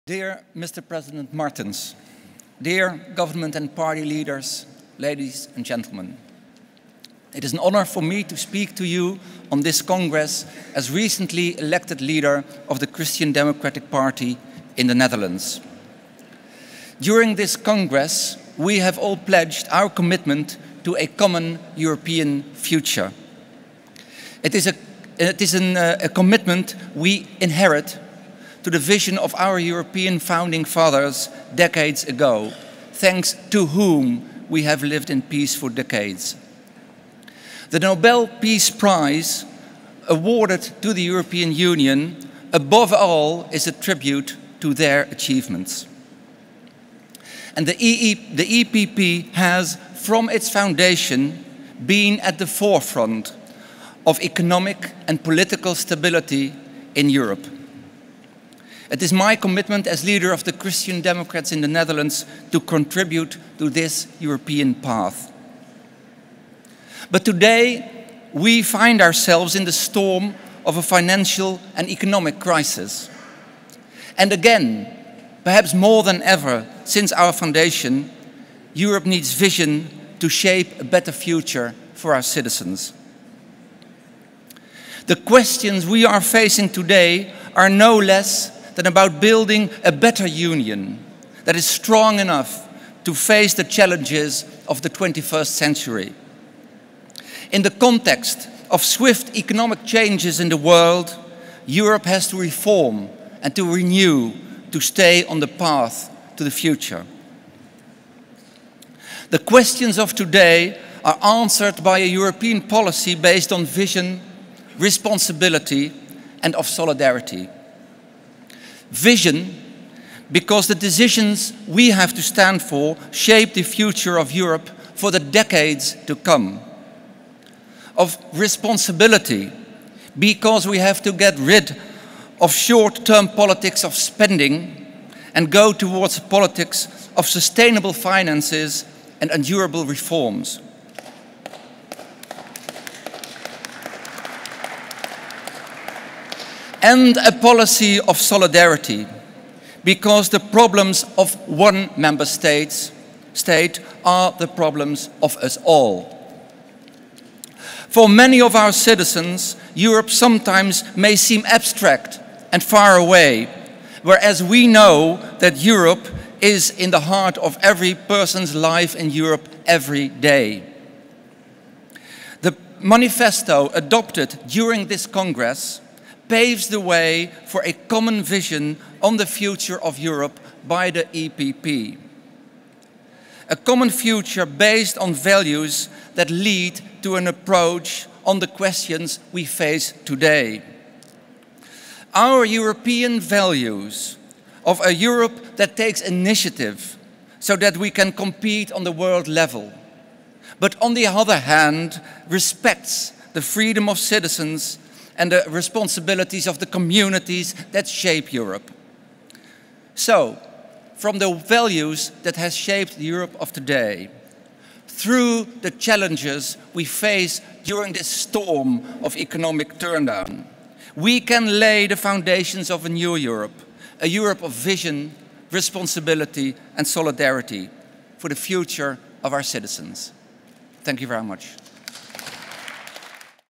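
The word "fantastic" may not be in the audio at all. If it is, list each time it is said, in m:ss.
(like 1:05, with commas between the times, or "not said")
not said.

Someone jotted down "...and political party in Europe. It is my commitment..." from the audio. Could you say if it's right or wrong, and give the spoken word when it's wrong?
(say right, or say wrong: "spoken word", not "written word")
wrong: "stability", not "party".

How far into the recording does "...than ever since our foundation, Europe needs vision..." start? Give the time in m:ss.
1:16.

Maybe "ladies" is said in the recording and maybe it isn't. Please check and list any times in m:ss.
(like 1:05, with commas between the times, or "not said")
0:04.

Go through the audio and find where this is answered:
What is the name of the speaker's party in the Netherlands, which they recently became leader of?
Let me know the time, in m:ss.
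0:12.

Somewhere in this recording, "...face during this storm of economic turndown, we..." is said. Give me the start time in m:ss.
3:36.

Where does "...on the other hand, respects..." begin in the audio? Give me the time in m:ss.
3:20.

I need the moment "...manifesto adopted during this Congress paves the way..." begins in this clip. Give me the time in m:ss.
2:52.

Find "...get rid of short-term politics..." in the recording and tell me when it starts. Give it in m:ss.
2:11.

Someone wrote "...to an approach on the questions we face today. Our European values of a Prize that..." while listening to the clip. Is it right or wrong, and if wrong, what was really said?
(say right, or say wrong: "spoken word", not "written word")
wrong: "Europe", not "Prize".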